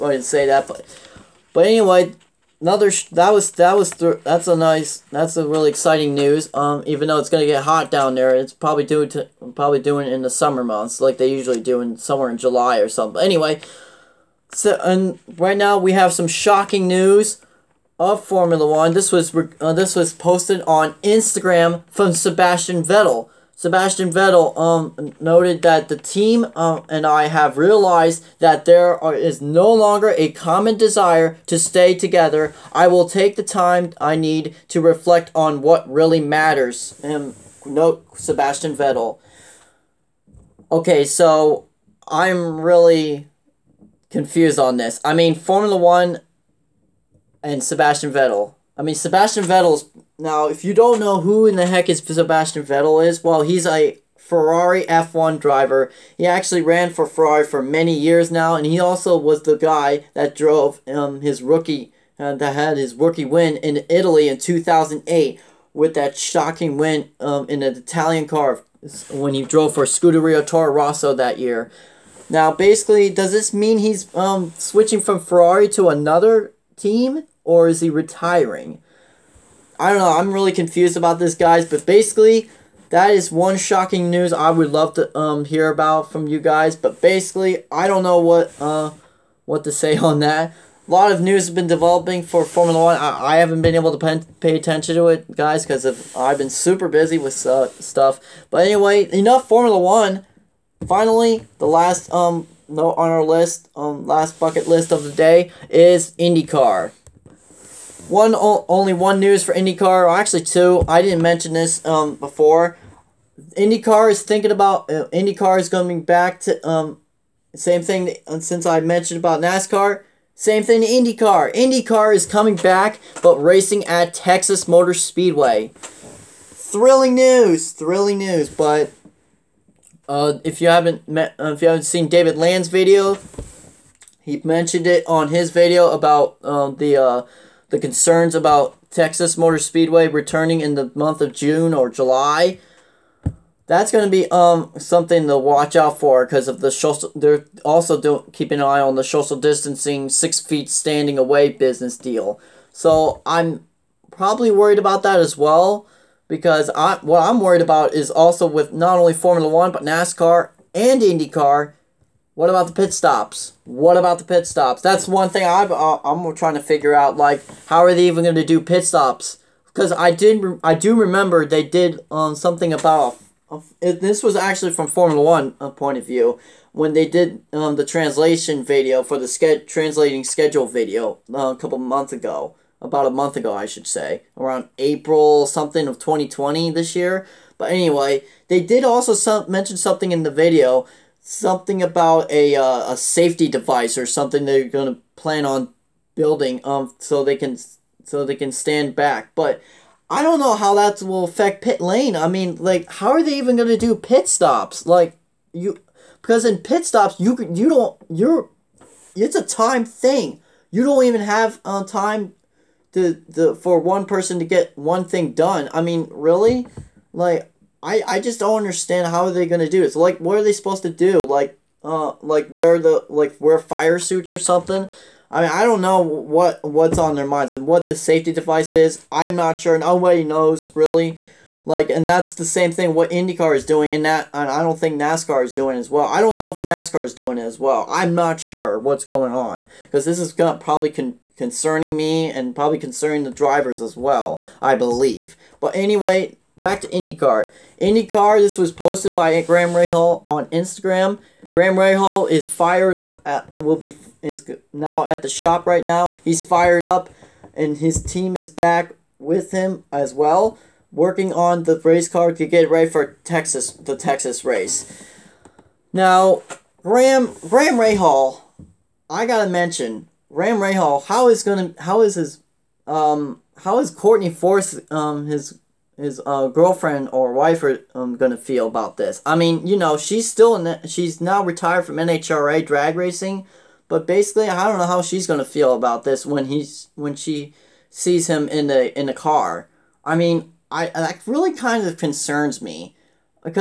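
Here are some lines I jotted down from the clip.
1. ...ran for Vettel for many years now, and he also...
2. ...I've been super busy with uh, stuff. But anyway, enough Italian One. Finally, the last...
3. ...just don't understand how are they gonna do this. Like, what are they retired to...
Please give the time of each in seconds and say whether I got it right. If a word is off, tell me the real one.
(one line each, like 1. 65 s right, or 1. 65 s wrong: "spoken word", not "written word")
1. 56 s wrong: "Ferrari", not "Vettel"
2. 96 s wrong: "Formula", not "Italian"
3. 218 s wrong: "supposed", not "retired".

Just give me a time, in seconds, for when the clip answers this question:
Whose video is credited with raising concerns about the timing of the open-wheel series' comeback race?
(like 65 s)
132 s.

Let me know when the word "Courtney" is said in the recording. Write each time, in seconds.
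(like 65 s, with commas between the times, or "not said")
273 s.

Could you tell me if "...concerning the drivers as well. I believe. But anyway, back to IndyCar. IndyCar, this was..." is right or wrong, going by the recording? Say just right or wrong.
right.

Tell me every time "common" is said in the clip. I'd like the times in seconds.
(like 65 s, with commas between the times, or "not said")
30 s.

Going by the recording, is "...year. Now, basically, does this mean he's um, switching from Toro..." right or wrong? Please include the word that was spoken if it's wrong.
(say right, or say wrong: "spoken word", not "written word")
wrong: "Ferrari", not "Toro".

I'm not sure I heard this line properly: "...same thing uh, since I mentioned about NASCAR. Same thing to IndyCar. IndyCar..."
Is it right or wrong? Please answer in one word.
right.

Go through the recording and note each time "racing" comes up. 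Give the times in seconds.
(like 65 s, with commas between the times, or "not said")
123 s, 282 s.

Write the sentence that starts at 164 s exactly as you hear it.
That's one thing I've, uh, I'm trying to figure out.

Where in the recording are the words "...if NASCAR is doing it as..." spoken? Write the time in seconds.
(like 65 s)
236 s.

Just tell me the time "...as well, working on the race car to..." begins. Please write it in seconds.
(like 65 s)
259 s.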